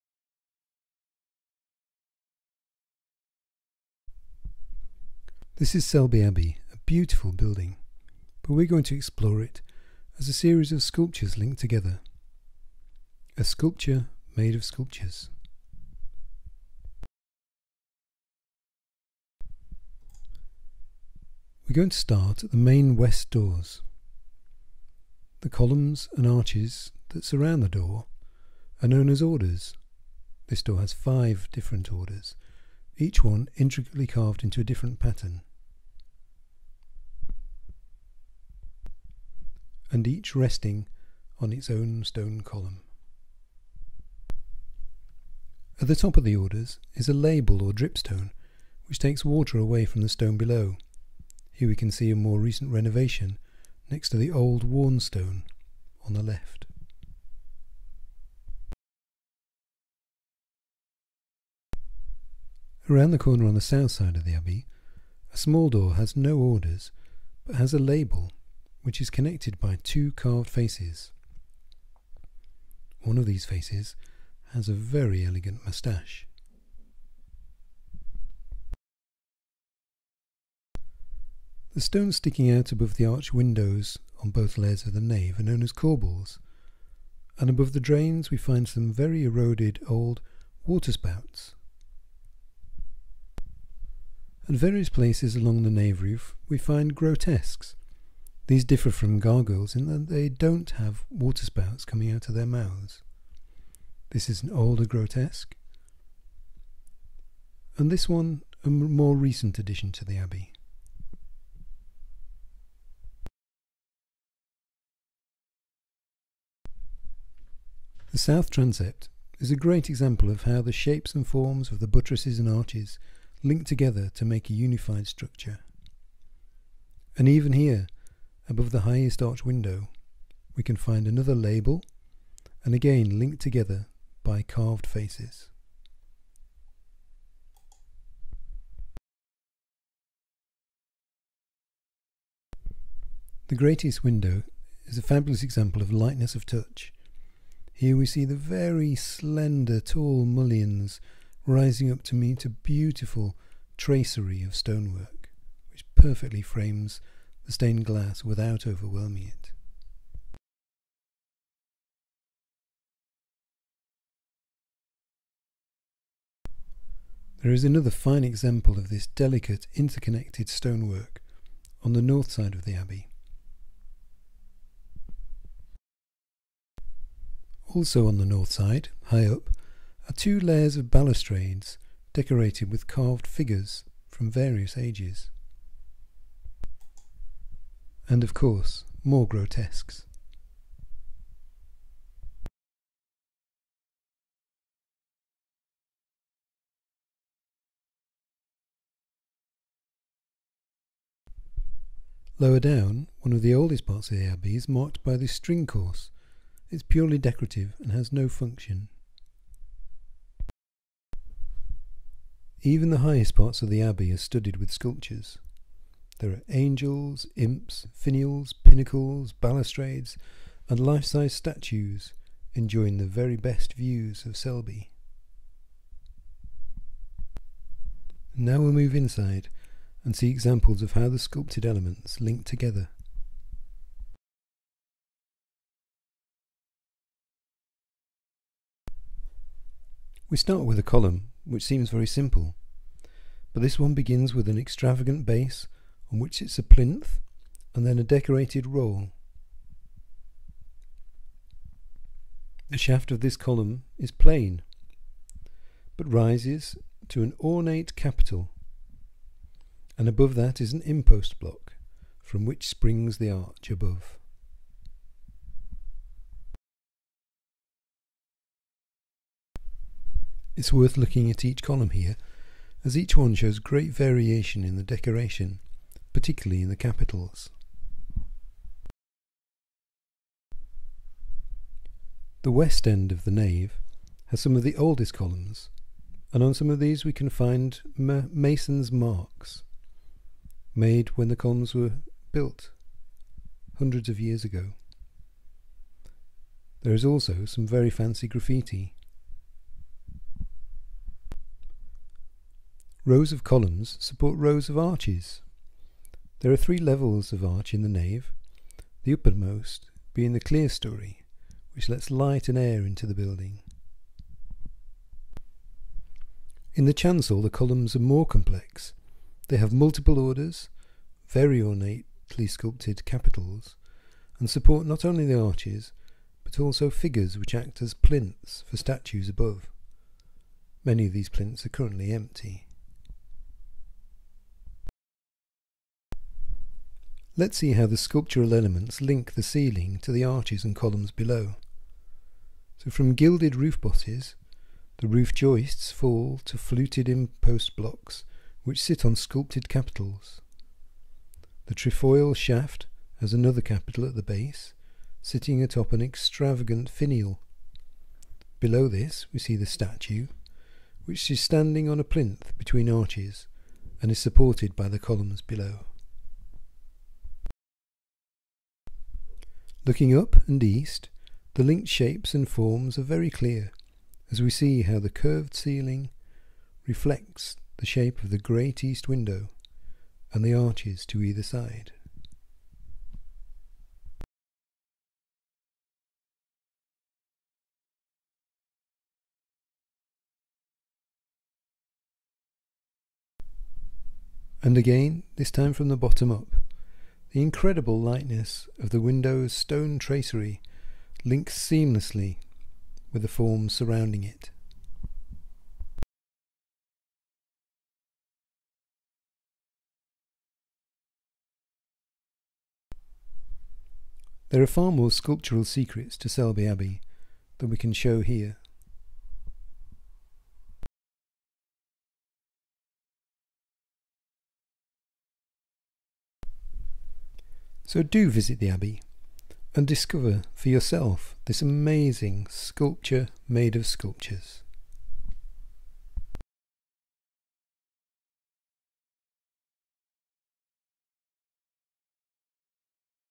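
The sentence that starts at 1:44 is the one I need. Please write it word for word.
This is an older grotesque, and this one a more recent addition to the abbey.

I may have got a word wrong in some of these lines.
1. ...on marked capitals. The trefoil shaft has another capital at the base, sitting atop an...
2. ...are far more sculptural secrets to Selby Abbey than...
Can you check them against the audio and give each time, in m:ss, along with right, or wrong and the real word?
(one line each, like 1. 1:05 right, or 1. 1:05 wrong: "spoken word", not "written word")
1. 5:49 wrong: "sculpted", not "marked"
2. 6:54 right.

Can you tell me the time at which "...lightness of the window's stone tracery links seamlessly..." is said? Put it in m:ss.
6:38.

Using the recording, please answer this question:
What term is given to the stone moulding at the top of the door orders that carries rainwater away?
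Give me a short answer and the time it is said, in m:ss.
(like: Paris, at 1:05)
dripstone, at 0:47.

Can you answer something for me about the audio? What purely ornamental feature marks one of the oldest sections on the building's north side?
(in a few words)
string course.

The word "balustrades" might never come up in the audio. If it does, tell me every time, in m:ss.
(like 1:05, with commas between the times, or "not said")
3:00, 3:39.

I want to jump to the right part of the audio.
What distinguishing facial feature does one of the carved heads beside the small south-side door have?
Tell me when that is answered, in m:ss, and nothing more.
1:15.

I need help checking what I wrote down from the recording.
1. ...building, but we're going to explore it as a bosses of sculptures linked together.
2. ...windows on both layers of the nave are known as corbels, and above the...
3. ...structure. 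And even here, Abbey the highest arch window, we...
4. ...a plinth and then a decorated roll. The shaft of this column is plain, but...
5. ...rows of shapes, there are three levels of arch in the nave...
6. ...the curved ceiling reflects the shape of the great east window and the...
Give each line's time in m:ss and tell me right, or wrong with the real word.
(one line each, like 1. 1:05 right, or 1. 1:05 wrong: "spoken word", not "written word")
1. 0:07 wrong: "series", not "bosses"
2. 1:23 right
3. 2:05 wrong: "Above", not "Abbey"
4. 4:06 right
5. 5:04 wrong: "arches", not "shapes"
6. 6:14 right.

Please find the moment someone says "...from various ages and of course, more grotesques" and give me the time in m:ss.
3:04.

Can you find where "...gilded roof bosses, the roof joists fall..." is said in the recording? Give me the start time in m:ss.
5:43.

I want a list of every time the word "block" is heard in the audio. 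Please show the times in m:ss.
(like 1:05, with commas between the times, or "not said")
4:21, 5:47.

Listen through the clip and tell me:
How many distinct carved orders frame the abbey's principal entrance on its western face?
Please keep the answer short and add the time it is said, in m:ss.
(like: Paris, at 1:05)
5, at 0:30.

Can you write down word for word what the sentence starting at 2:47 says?
There is another fine example of this delicate interconnected stonework on the north side of the abbey.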